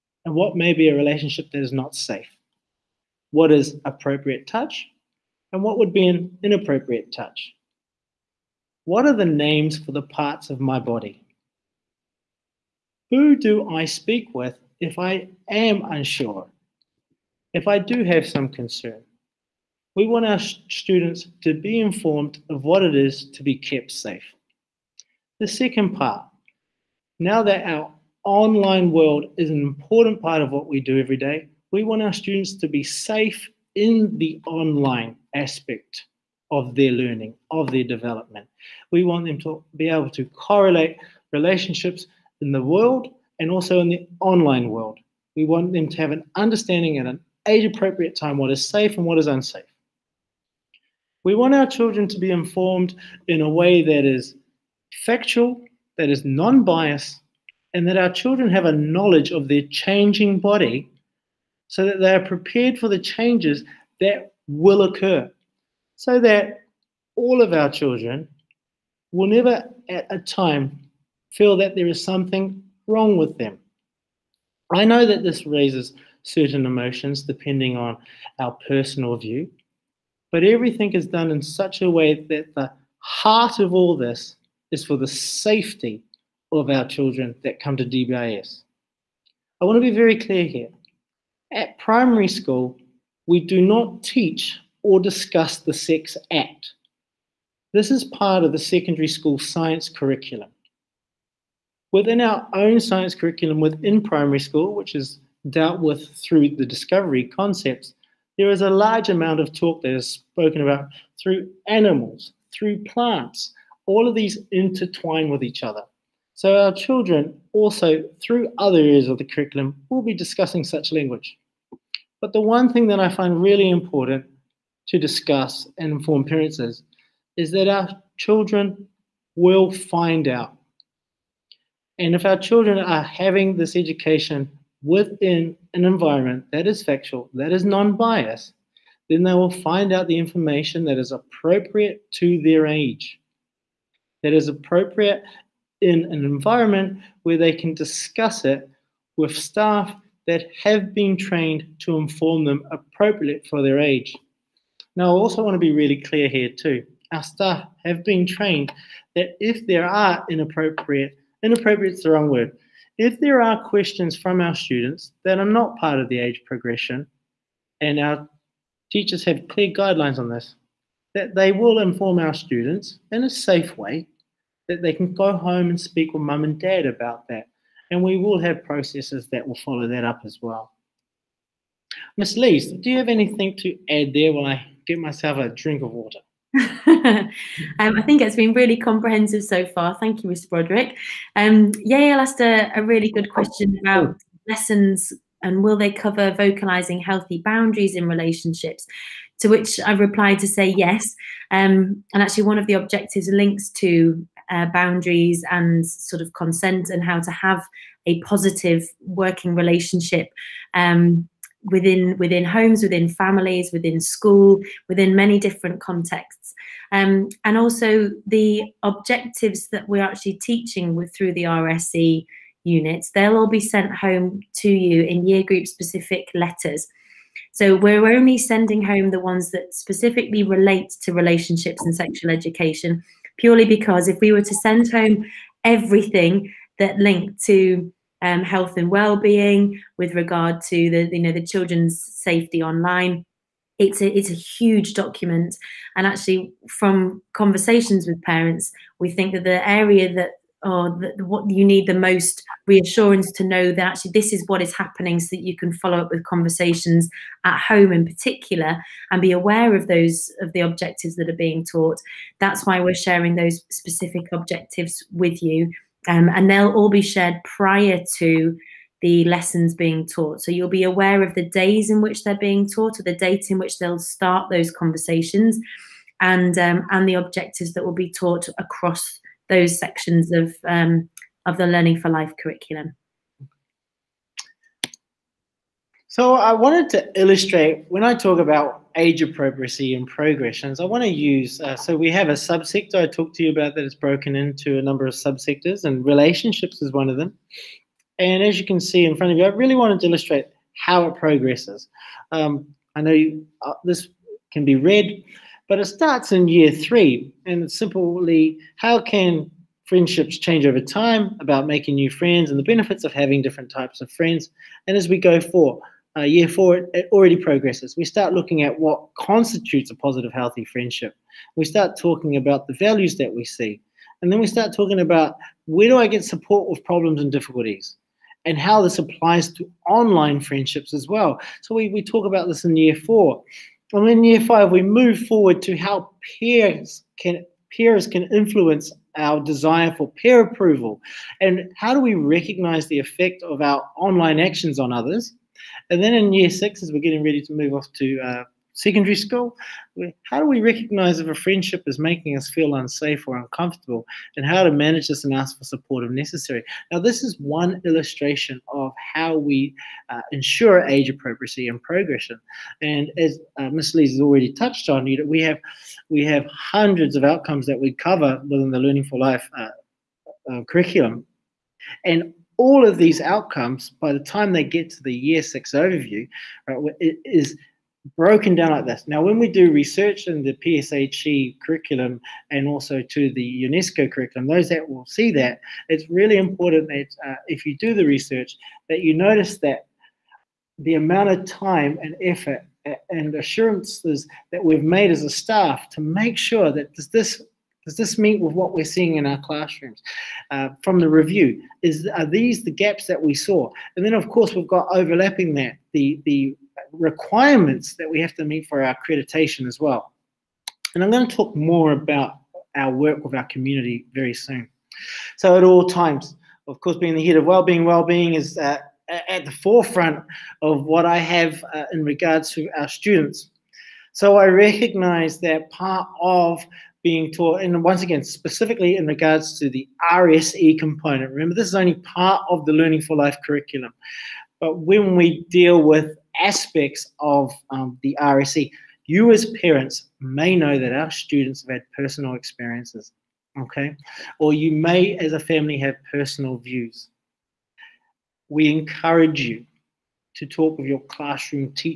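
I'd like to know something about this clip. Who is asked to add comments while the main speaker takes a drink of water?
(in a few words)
Miss Lees.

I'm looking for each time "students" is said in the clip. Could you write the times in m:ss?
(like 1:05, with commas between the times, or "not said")
0:20, 0:32, 2:44, 2:52, 7:02, 7:21.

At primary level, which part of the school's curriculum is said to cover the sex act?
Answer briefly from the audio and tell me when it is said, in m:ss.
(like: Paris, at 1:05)
secondary school science curriculum, at 1:38.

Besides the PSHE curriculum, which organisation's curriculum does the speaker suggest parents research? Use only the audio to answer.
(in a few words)
UNESCO.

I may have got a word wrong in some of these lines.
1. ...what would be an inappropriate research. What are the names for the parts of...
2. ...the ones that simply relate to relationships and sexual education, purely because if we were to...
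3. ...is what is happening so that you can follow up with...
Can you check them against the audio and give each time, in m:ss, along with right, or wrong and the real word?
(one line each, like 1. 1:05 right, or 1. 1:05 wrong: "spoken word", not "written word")
1. 0:05 wrong: "touch", not "research"
2. 3:49 wrong: "specifically", not "simply"
3. 4:14 right.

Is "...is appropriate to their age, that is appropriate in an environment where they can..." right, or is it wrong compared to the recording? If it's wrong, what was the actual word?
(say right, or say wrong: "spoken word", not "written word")
right.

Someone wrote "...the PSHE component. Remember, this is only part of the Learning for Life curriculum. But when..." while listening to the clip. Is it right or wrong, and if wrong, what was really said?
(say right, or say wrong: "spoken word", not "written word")
wrong: "RSE", not "PSHE".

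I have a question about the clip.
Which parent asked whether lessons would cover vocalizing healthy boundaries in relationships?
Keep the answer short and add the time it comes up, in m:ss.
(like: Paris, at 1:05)
Yael, at 3:11.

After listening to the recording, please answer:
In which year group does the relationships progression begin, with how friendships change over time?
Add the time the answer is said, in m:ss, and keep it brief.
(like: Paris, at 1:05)
Year 3, at 5:06.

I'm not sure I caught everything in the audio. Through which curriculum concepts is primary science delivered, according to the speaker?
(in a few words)
discovery concepts.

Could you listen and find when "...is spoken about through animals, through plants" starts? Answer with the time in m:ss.
1:49.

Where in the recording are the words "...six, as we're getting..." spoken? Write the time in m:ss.
5:46.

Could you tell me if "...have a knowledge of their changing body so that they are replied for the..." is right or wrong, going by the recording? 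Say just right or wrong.
wrong.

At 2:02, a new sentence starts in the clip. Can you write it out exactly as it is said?
But the one thing that I find really important to discuss and inform parents is, is that our children will find out.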